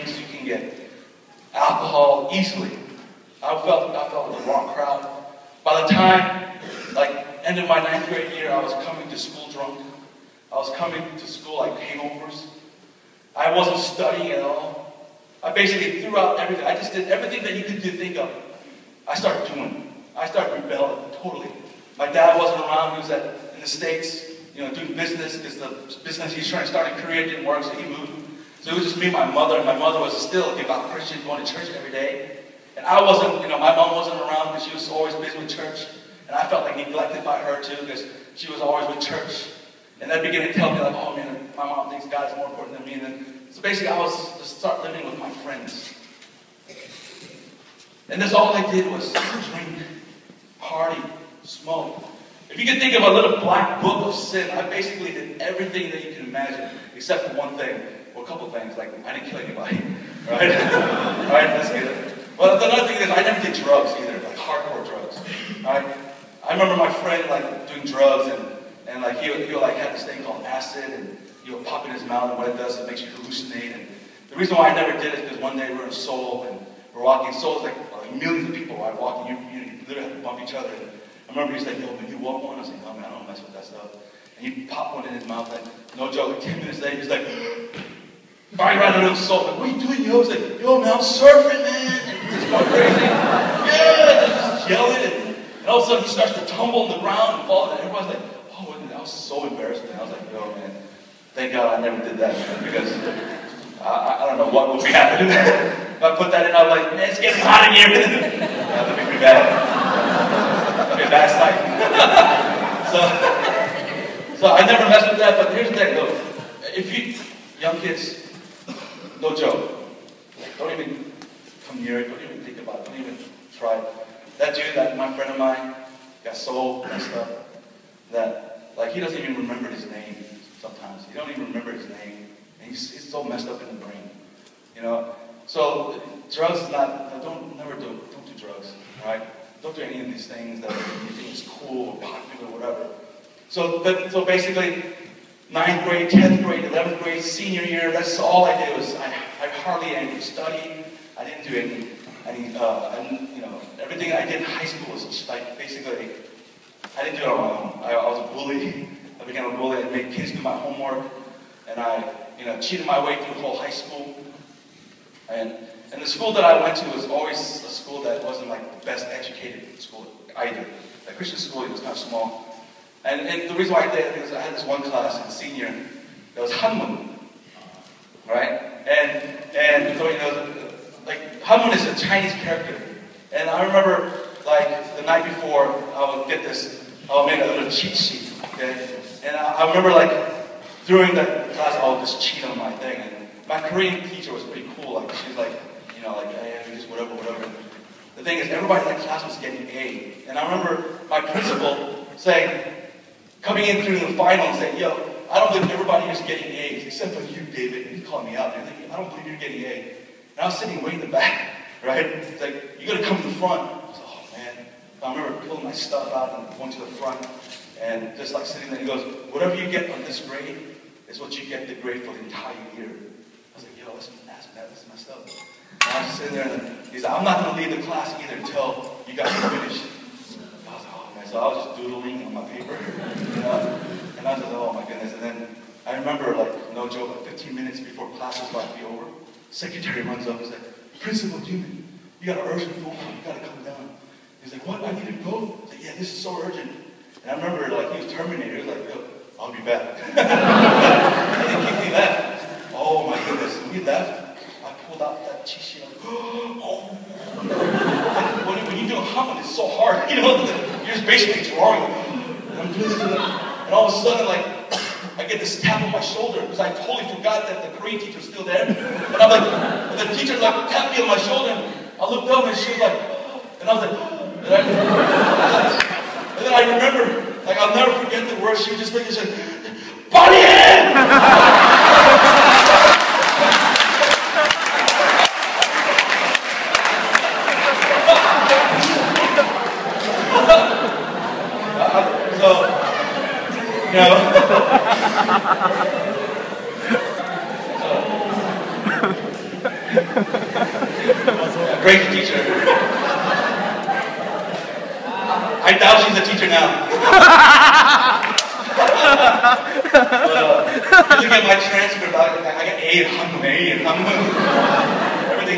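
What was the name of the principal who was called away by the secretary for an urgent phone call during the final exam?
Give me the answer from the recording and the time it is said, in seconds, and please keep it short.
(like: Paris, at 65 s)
Principal Newman, at 241 s.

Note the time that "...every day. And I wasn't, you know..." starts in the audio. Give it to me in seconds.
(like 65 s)
31 s.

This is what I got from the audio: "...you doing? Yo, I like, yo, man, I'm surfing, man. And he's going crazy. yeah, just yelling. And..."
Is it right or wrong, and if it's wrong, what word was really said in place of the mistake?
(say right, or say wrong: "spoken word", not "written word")
right.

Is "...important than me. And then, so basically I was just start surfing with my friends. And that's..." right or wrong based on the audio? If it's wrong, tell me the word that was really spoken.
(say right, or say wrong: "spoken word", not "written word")
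wrong: "living", not "surfing".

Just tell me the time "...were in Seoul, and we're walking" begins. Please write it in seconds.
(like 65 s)
75 s.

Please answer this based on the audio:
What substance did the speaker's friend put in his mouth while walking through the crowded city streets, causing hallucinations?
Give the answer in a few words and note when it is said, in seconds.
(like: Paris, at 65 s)
Acid, at 70 s.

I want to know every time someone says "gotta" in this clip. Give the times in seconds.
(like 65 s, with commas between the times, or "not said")
212 s, 243 s.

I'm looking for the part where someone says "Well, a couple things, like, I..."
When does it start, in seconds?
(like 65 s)
58 s.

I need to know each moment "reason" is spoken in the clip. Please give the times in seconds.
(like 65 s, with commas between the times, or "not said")
74 s, 173 s.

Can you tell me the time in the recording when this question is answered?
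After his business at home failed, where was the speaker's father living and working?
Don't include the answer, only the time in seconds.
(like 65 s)
23 s.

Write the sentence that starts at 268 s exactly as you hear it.
And I'm like, and the teacher like tapped me on my shoulder.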